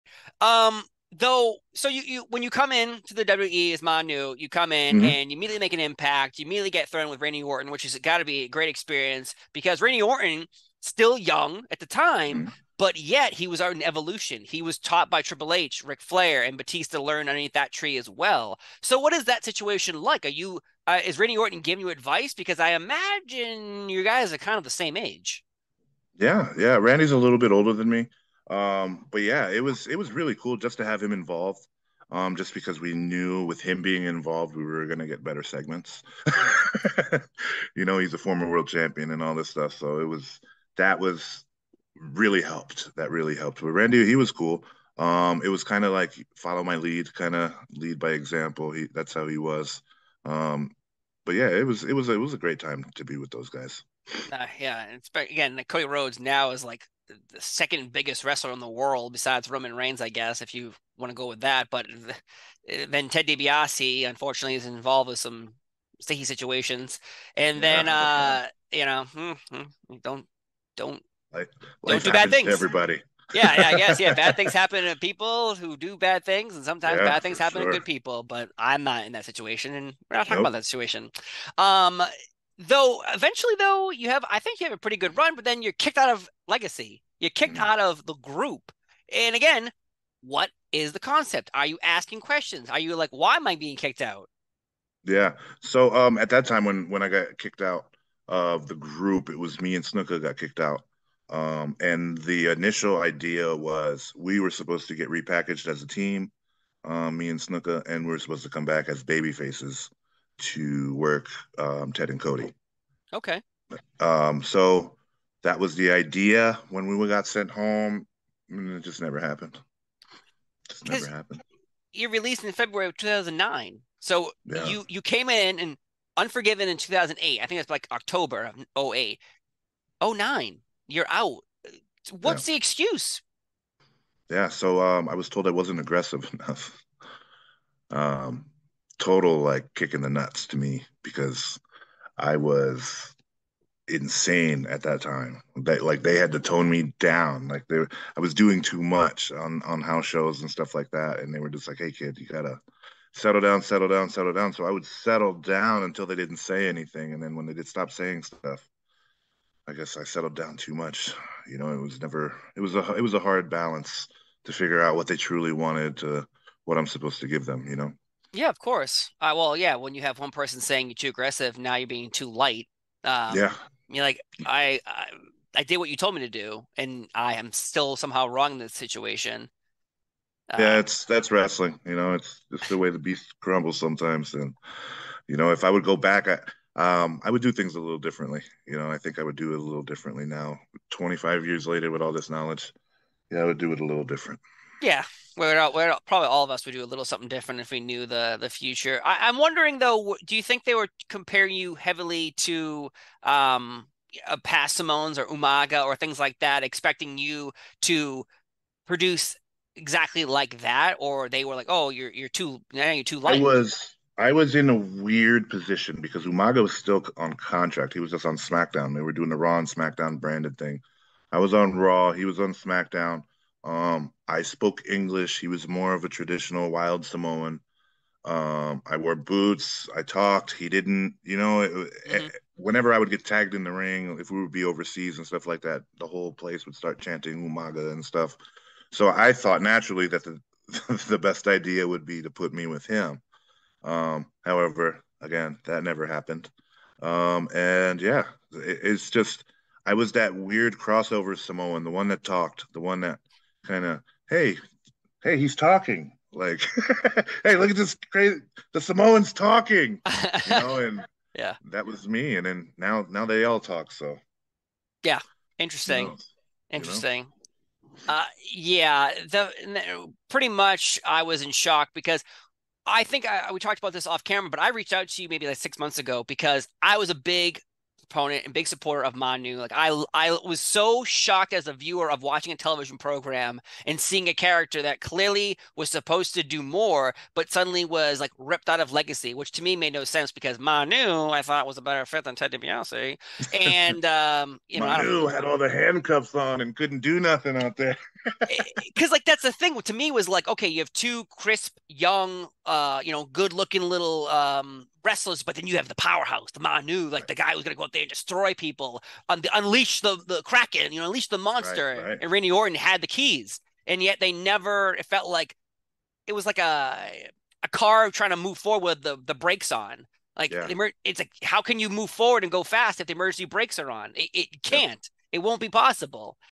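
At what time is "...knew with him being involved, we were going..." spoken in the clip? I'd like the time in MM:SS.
00:32.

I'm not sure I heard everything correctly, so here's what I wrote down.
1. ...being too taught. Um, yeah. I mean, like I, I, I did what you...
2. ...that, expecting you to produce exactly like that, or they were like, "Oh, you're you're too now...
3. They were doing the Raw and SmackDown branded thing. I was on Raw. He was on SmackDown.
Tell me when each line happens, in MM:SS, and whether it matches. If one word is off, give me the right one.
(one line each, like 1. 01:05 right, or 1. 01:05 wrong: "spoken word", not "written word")
1. 02:51 wrong: "light", not "taught"
2. 03:26 right
3. 03:38 right.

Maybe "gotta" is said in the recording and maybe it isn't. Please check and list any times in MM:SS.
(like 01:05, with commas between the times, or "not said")
02:32.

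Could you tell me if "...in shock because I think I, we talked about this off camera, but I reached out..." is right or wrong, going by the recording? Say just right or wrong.
right.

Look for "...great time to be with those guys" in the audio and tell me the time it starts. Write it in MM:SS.
00:52.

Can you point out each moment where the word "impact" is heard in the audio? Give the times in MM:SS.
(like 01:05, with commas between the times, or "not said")
00:05.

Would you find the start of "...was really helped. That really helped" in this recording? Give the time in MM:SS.
00:40.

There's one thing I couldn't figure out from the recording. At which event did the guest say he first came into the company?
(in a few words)
Unforgiven.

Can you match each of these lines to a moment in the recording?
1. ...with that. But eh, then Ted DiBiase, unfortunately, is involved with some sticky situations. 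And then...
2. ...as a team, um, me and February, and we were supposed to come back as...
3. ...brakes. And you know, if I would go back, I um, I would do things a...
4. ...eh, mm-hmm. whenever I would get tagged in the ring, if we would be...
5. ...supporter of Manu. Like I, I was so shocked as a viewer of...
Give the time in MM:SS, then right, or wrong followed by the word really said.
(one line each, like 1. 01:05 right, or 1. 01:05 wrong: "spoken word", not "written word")
1. 01:01 right
2. 01:45 wrong: "Snuka", not "February"
3. 03:03 wrong: "sometimes", not "brakes"
4. 03:52 right
5. 04:38 right.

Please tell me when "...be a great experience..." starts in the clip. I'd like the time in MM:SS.
00:08.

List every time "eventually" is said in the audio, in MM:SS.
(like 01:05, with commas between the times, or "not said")
01:23.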